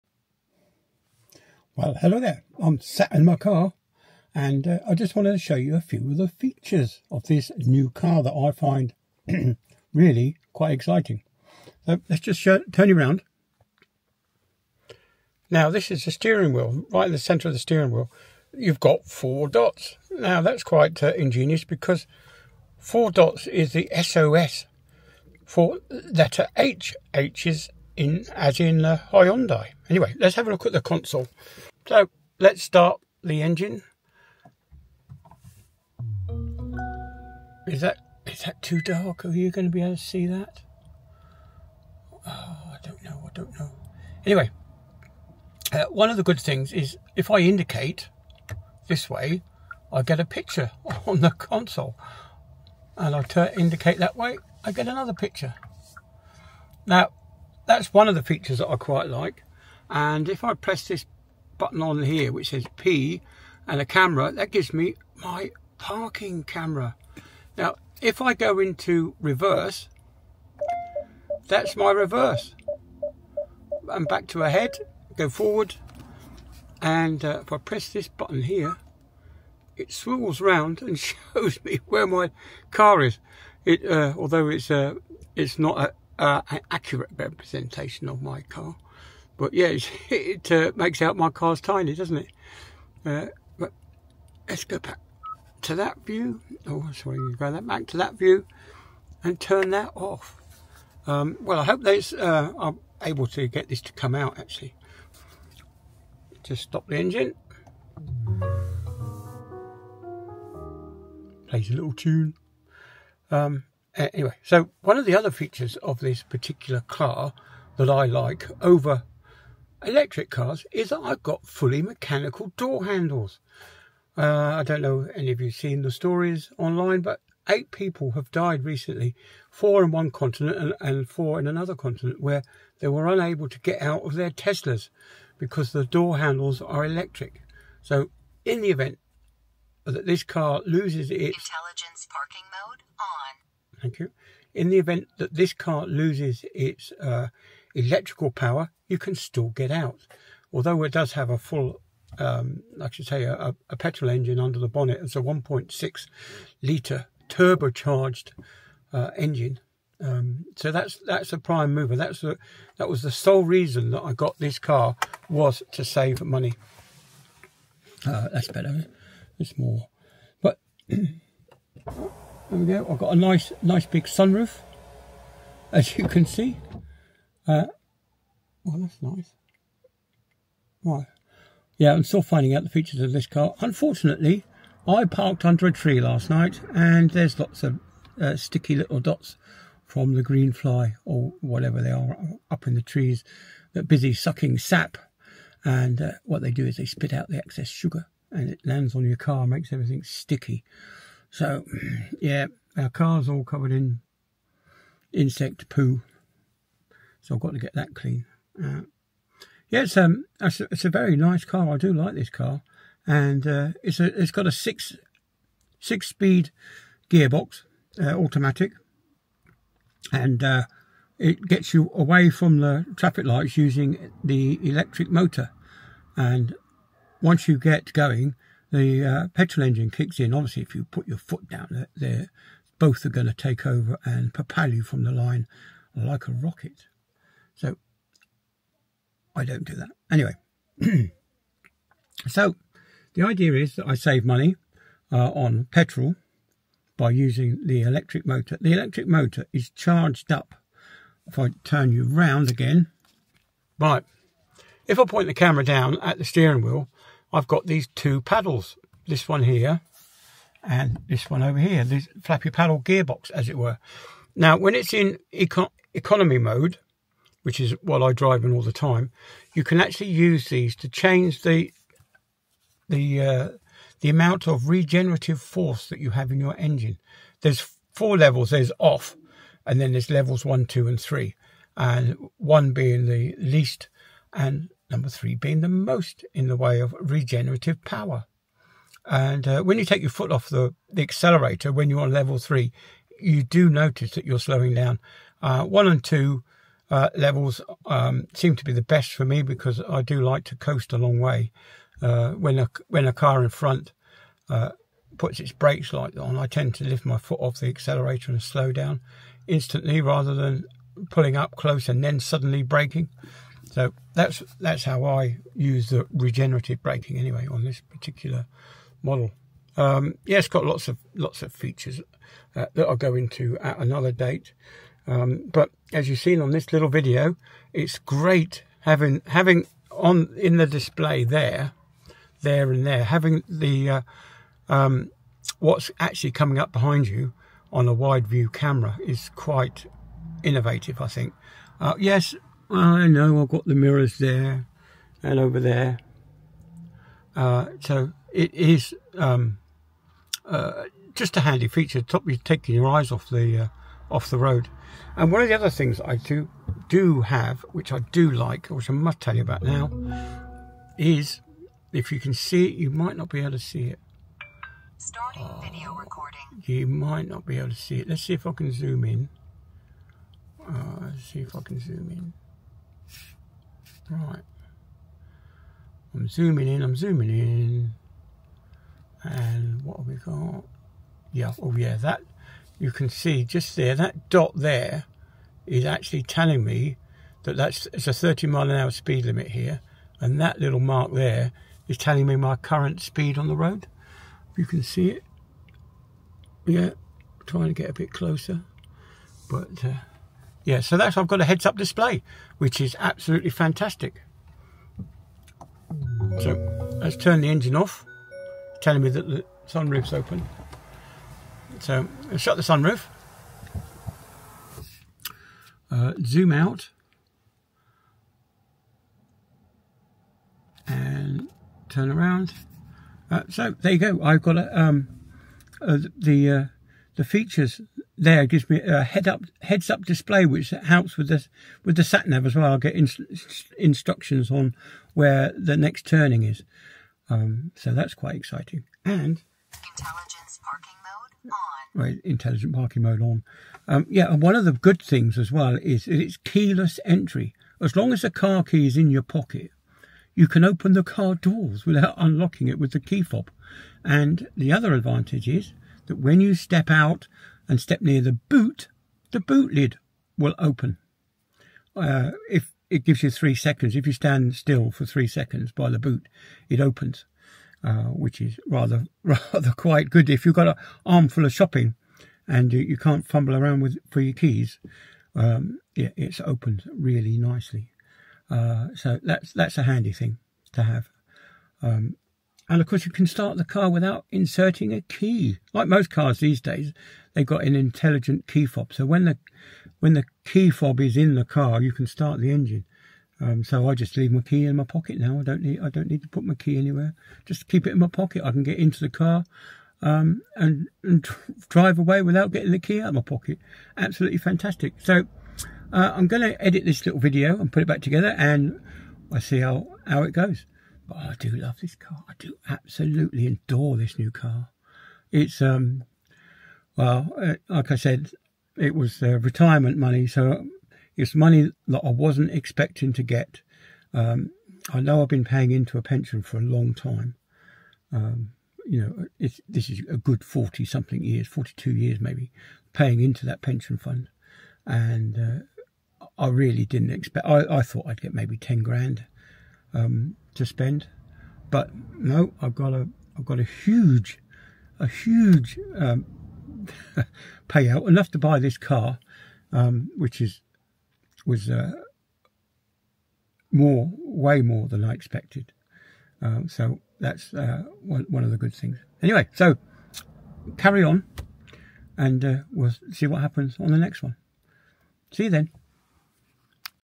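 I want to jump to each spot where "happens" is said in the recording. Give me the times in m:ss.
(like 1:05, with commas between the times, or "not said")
9:23.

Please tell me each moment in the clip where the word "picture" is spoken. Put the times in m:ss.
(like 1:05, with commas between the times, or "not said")
0:50, 0:55.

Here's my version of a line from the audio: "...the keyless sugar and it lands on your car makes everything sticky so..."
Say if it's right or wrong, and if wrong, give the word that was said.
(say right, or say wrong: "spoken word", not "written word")
wrong: "excess", not "keyless".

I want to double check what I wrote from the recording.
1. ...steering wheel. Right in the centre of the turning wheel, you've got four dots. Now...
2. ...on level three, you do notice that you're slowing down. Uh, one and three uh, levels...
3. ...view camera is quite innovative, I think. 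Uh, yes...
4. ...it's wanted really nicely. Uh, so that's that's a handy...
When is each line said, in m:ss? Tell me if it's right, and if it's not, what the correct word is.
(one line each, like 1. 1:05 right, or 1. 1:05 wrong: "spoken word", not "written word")
1. 0:16 wrong: "steering", not "turning"
2. 4:52 wrong: "two", not "three"
3. 5:38 right
4. 7:55 wrong: "opened", not "wanted".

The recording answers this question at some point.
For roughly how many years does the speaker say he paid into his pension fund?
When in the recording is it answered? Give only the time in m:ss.
8:51.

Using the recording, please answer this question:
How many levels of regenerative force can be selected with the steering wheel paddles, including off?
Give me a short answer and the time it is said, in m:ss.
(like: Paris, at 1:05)
4, at 4:37.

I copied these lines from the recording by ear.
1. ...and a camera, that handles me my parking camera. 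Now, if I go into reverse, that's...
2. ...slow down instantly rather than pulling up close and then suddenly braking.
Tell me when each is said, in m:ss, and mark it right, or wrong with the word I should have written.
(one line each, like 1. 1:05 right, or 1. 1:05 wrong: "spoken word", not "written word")
1. 1:03 wrong: "gives", not "handles"
2. 5:08 right.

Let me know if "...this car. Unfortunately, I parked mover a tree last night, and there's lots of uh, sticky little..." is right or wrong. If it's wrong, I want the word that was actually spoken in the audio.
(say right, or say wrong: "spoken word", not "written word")
wrong: "under", not "mover".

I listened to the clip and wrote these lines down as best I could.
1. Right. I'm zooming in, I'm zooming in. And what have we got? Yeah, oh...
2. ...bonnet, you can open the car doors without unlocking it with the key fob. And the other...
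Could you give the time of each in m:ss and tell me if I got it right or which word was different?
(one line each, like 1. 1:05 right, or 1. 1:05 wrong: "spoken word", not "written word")
1. 6:14 right
2. 7:29 wrong: "pocket", not "bonnet".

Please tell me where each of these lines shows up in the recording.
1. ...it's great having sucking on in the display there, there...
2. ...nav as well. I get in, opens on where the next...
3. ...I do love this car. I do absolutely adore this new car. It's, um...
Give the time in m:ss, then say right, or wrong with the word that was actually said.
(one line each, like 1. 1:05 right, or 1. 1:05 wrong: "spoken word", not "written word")
1. 5:27 wrong: "having", not "sucking"
2. 7:12 wrong: "instructions", not "opens"
3. 8:31 right.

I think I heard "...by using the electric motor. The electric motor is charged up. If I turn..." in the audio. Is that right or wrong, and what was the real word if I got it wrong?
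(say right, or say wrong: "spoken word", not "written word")
right.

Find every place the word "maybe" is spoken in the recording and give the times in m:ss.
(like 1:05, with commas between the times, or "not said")
8:52, 8:58.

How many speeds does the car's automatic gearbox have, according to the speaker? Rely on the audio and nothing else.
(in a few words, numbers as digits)
6.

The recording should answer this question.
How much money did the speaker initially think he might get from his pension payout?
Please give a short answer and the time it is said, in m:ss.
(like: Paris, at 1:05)
10 grand, at 8:58.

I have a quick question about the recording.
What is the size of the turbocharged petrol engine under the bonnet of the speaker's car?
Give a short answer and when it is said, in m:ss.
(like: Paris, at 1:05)
1.6 litre, at 2:35.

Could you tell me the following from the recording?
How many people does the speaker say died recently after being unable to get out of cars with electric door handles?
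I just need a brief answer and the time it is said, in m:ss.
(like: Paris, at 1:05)
8, at 2:07.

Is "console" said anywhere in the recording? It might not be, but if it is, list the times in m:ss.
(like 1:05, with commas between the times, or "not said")
0:30, 0:51.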